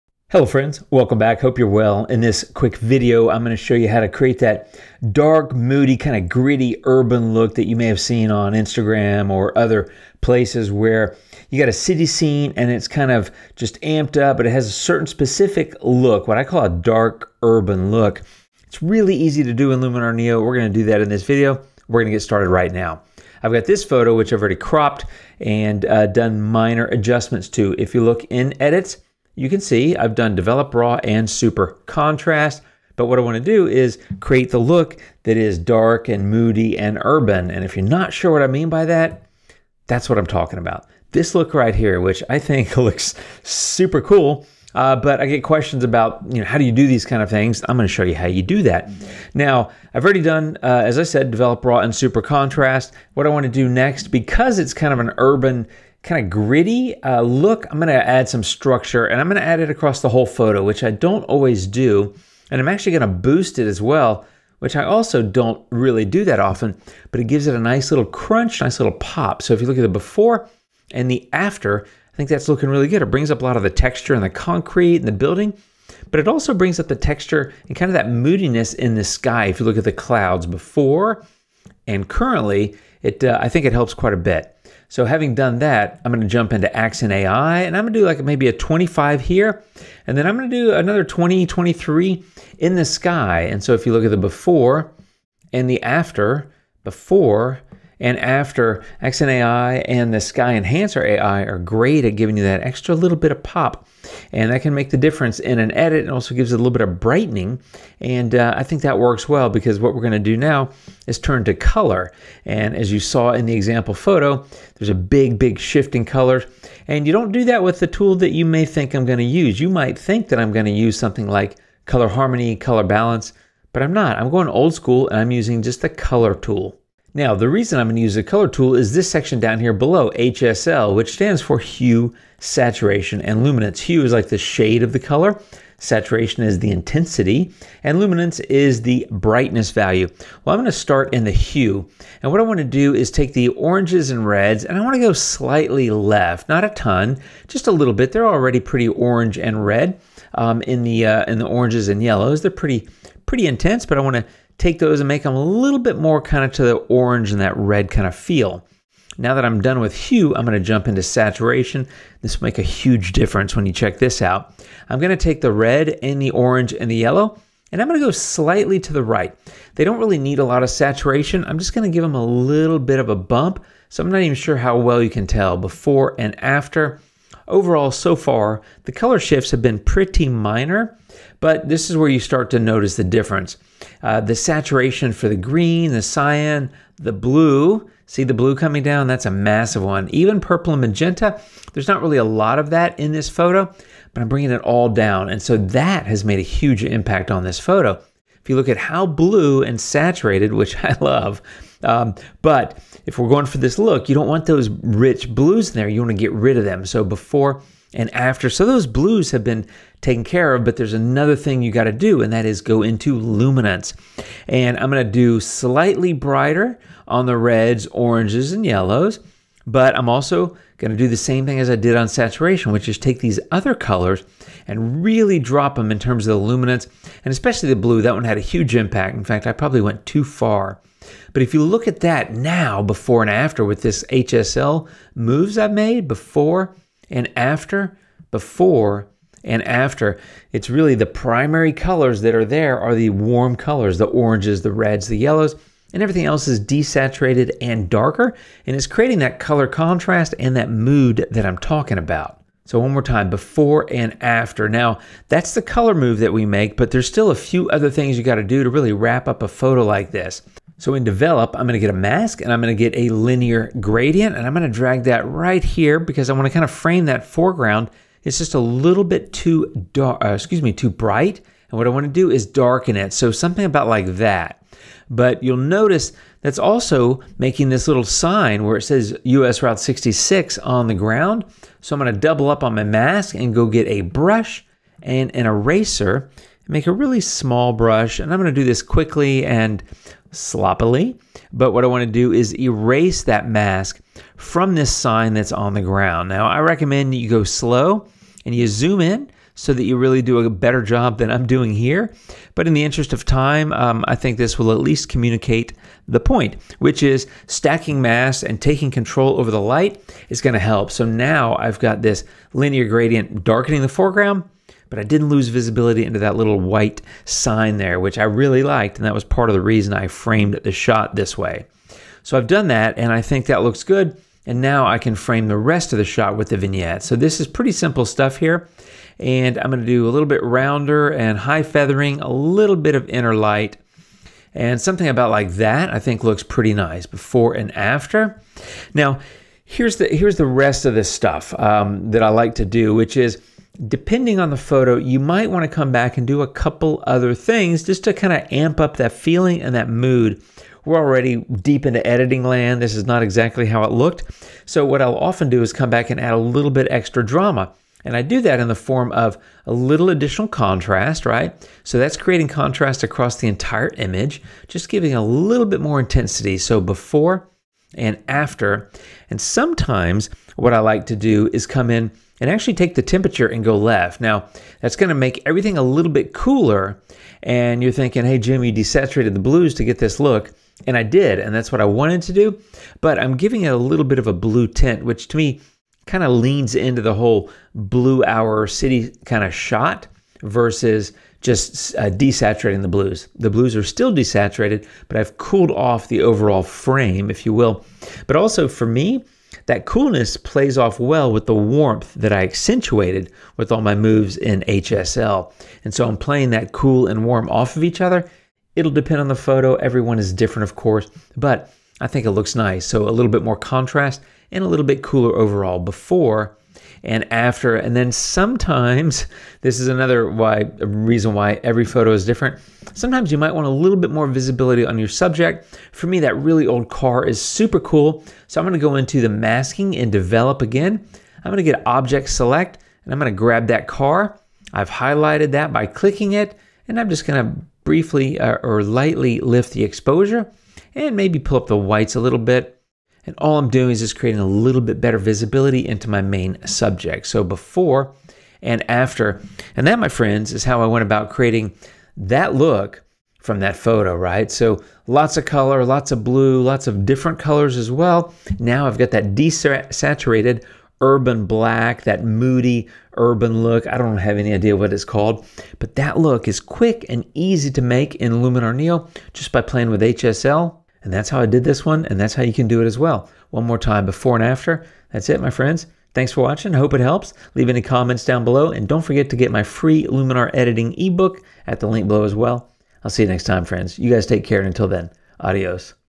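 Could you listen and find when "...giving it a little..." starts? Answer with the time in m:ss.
6:23.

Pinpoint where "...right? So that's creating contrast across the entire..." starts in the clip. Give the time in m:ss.
6:01.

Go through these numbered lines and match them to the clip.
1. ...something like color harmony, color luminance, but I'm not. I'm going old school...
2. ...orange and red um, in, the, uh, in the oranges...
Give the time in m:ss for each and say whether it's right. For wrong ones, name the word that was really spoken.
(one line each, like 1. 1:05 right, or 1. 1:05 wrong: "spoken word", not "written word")
1. 2:00 wrong: "balance", not "luminance"
2. 2:28 right.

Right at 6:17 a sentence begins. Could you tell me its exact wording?
And you're thinking, hey, Jim, you desaturated the blues to get this look.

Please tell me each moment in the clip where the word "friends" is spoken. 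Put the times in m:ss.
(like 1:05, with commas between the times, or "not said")
0:00, 7:30, 7:55, 8:03.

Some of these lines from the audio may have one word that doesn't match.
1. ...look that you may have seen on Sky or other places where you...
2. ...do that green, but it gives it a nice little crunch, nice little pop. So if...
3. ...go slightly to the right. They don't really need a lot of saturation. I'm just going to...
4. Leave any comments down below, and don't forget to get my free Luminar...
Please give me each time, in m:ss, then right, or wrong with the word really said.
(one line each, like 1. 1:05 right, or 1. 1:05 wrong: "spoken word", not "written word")
1. 0:07 wrong: "Instagram", not "Sky"
2. 1:06 wrong: "often", not "green"
3. 2:48 right
4. 7:57 right.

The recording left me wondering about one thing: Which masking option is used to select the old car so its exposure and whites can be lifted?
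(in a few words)
object select.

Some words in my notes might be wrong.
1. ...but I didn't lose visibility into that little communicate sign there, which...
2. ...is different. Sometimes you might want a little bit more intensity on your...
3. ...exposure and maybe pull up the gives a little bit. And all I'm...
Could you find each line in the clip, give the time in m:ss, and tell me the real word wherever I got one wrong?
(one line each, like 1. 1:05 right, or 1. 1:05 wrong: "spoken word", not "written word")
1. 5:14 wrong: "white", not "communicate"
2. 7:02 wrong: "visibility", not "intensity"
3. 7:19 wrong: "whites", not "gives".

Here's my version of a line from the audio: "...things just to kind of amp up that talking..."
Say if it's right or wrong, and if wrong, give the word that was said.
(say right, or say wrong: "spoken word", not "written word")
wrong: "feeling", not "talking".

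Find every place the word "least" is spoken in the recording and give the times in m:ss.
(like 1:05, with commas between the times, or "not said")
5:04.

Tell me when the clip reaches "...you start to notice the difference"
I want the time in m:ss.
3:02.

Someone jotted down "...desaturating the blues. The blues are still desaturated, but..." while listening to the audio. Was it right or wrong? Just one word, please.
right.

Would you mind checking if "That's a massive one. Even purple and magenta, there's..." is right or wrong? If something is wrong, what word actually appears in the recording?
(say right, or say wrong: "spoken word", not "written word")
right.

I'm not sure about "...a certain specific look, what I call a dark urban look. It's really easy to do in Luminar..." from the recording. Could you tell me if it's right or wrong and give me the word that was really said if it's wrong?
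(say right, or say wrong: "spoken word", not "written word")
right.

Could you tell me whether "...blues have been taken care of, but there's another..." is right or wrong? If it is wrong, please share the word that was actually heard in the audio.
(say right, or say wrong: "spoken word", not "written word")
right.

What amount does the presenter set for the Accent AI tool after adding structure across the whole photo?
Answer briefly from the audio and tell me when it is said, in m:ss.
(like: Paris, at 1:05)
25, at 1:28.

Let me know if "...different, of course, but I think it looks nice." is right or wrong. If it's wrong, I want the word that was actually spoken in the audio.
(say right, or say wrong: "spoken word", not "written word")
right.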